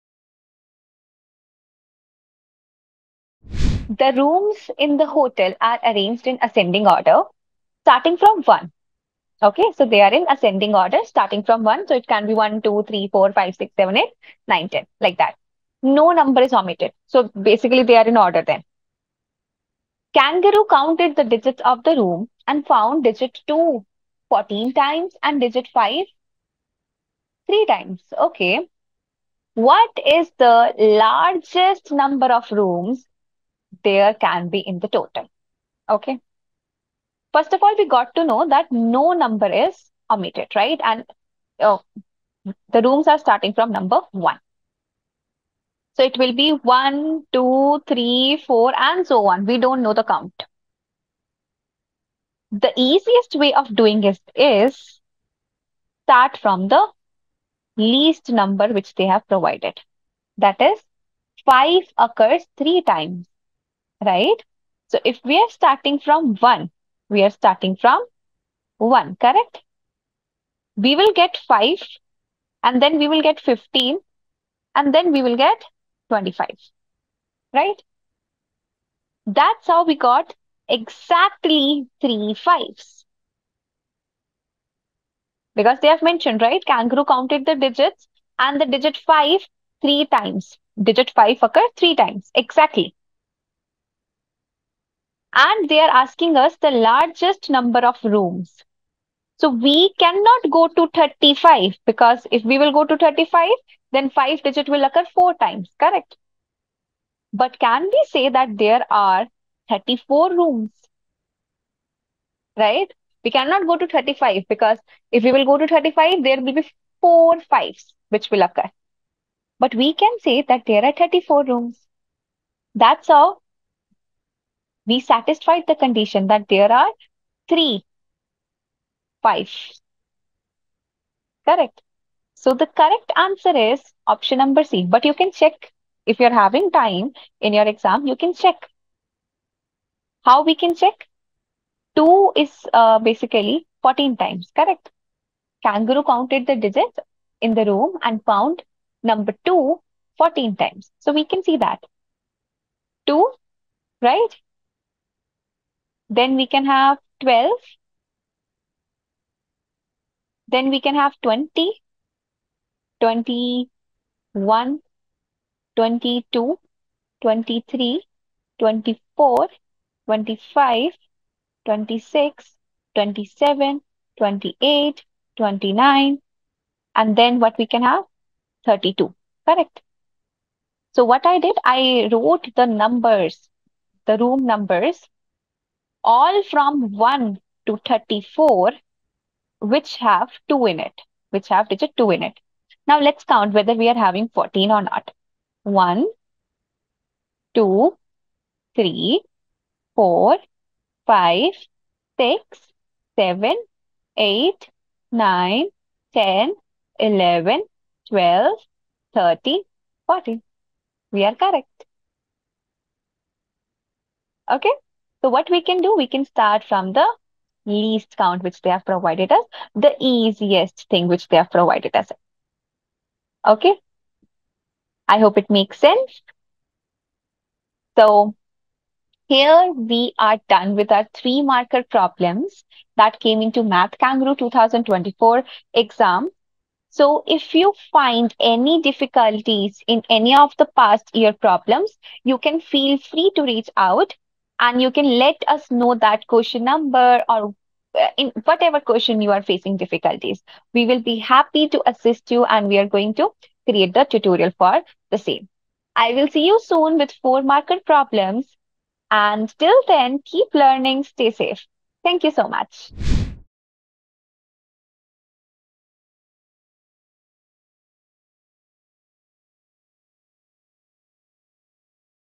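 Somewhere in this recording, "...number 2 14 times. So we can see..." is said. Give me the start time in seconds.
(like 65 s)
149 s.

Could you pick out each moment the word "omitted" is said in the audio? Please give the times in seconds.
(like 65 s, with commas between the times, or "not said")
16 s, 40 s.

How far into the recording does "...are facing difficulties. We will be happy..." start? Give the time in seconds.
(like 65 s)
249 s.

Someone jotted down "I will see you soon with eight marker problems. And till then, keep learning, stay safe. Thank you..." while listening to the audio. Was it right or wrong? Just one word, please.
wrong.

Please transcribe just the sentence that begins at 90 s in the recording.
Digit 5 occurred three times, exactly and they are asking us the largest number of rooms.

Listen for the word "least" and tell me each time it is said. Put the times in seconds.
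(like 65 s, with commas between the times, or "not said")
57 s, 217 s.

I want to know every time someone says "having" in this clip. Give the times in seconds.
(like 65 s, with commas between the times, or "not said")
136 s, 193 s.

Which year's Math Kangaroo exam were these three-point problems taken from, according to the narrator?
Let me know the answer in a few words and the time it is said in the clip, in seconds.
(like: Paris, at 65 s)
2024, at 234 s.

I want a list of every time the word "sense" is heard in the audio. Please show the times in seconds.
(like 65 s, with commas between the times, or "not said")
225 s.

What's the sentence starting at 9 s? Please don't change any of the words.
Okay, so they are in ascending order, starting from one.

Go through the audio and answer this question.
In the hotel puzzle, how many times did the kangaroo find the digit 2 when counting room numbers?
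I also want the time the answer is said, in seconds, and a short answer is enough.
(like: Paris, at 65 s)
14 times, at 23 s.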